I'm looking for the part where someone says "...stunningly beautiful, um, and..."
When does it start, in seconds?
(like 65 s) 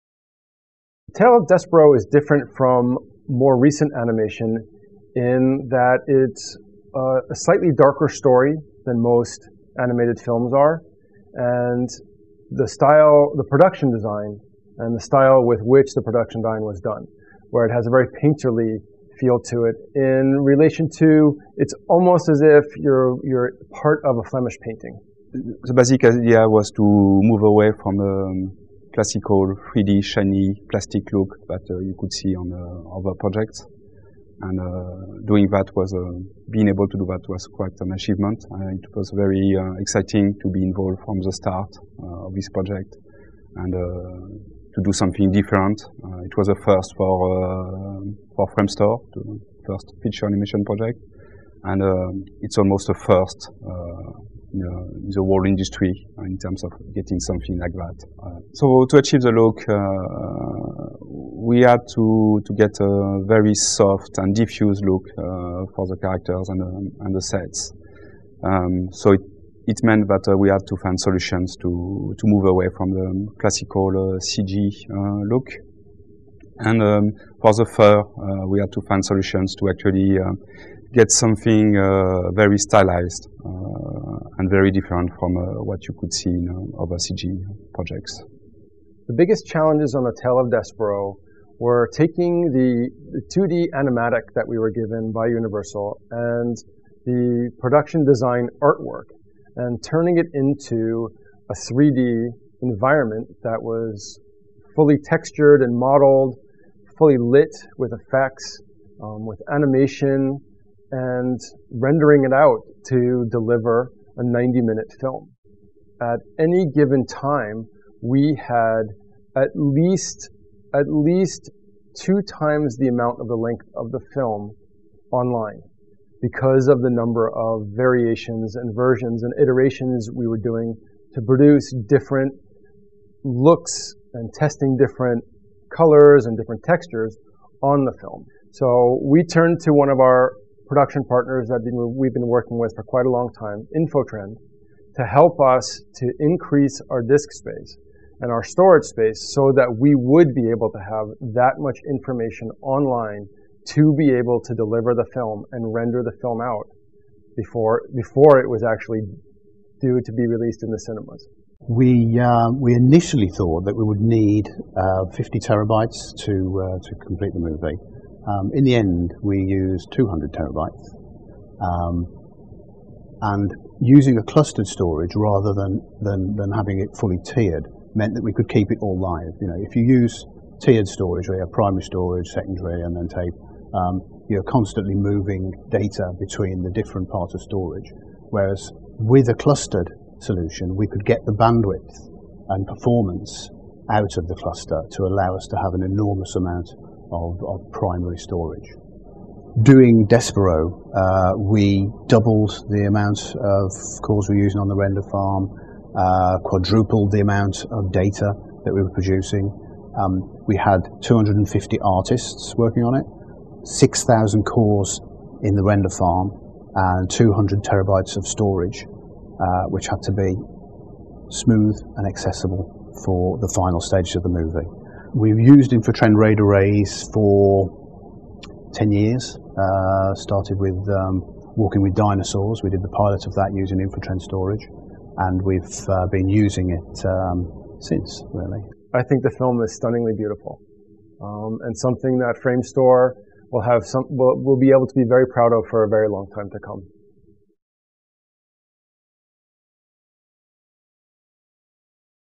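239 s.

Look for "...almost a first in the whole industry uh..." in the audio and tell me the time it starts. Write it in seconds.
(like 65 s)
52 s.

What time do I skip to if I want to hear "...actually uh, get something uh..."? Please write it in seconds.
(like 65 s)
79 s.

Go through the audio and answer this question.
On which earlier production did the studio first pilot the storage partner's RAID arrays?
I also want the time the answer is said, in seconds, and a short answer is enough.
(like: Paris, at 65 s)
Walking with Dinosaurs, at 231 s.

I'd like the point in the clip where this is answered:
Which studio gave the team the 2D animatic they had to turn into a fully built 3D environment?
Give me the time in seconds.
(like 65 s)
95 s.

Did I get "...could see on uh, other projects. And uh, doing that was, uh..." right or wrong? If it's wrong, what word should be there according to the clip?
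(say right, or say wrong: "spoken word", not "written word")
right.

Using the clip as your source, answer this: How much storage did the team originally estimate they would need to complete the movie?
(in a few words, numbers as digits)
50 terabytes.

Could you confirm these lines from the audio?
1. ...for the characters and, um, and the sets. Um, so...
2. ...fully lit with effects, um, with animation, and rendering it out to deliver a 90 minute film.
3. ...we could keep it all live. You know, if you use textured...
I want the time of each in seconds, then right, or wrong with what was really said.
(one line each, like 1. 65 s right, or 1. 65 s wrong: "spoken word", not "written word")
1. 65 s right
2. 106 s right
3. 178 s wrong: "tiered", not "textured".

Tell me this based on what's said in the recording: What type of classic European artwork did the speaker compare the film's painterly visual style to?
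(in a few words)
Flemish painting.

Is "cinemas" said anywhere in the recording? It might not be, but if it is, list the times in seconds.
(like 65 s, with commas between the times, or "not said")
160 s.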